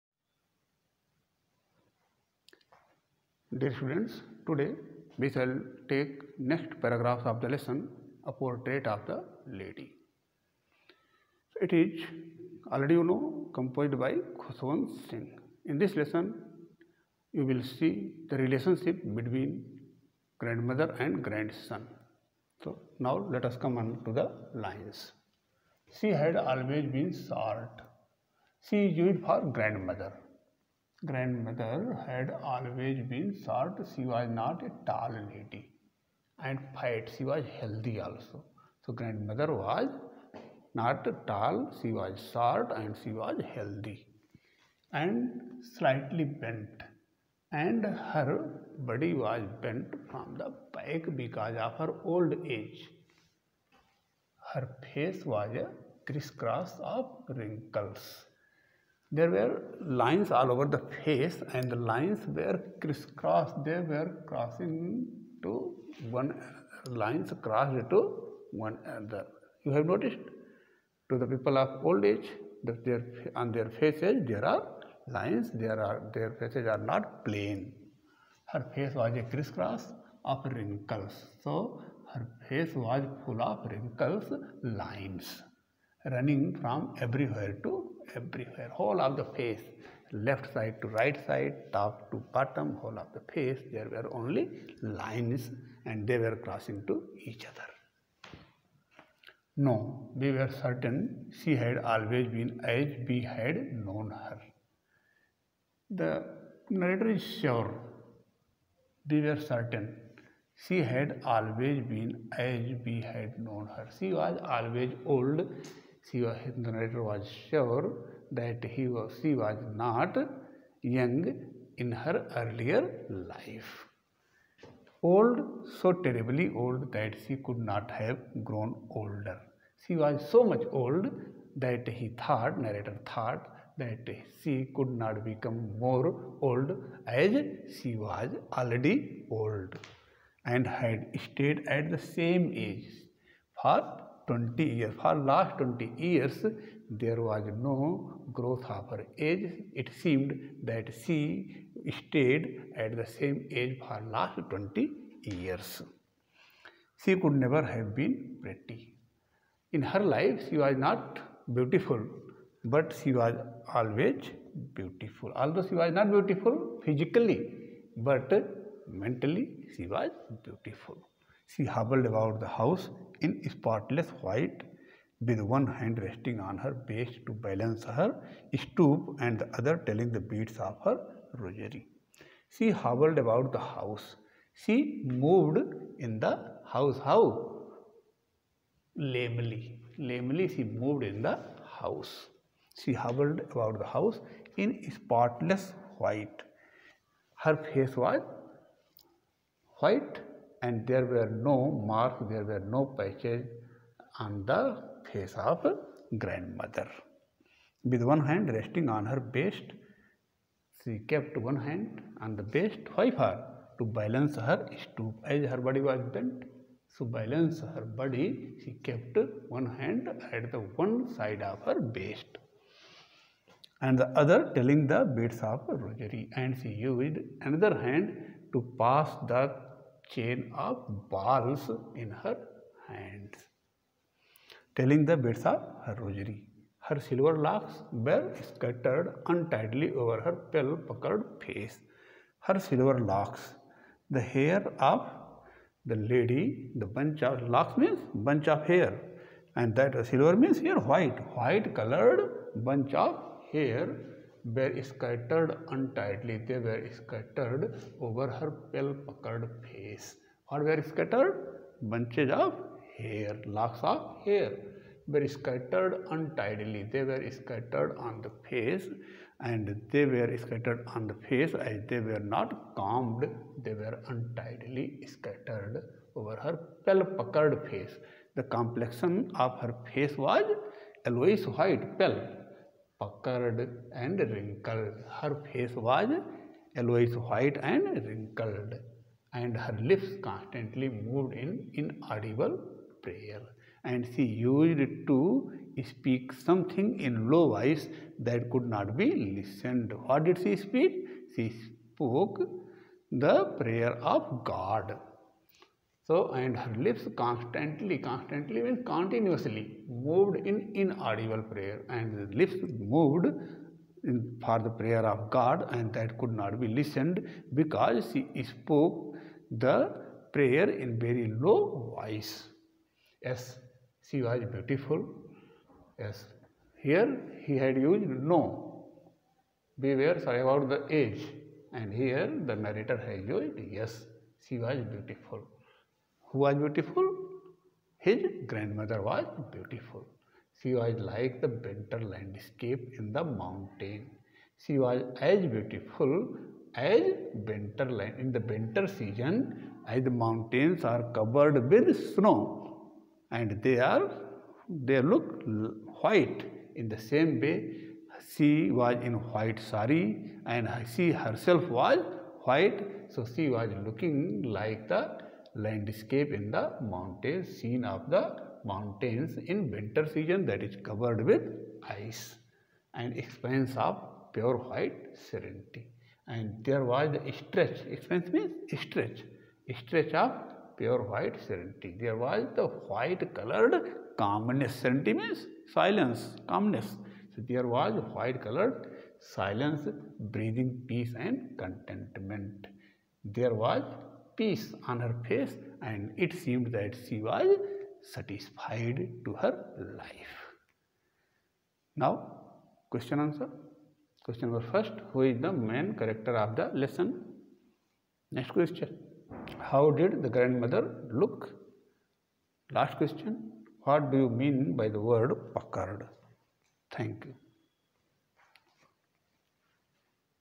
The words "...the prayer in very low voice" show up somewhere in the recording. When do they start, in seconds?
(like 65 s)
319 s.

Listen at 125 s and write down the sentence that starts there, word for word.
Old, so terribly old that she could not have grown older.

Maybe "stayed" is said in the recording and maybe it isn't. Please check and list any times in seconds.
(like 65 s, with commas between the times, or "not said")
141 s, 151 s.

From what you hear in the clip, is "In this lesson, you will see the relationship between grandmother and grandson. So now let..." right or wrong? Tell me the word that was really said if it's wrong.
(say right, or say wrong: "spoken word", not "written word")
right.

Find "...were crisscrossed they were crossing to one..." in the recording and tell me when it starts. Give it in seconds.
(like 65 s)
62 s.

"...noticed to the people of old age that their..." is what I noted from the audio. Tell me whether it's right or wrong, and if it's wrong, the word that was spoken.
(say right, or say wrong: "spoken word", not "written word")
right.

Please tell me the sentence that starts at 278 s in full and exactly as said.
The complexion of her face was yellowish white, pale puckered and wrinkled.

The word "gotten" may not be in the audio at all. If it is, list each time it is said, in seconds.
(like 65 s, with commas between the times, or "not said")
not said.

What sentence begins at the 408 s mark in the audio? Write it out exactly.
Next question, how did the grandmother look?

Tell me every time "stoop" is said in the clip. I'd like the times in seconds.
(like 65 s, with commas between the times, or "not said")
178 s, 214 s.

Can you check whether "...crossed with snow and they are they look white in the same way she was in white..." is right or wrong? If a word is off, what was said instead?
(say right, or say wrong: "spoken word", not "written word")
wrong: "covered", not "crossed".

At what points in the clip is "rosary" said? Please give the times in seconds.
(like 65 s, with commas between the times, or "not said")
181 s, 225 s, 235 s.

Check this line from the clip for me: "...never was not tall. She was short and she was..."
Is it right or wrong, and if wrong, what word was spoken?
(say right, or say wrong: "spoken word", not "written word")
wrong: "grandmother", not "never".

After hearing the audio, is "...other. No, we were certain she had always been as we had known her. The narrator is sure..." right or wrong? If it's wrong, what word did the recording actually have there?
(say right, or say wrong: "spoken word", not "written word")
right.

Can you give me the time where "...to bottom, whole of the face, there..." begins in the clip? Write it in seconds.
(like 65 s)
92 s.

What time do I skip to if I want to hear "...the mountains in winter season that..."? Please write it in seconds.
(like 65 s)
368 s.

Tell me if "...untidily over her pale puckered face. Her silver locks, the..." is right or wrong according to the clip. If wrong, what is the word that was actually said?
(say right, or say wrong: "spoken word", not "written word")
right.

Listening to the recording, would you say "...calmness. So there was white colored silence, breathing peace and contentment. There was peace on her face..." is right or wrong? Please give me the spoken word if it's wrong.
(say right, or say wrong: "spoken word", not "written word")
right.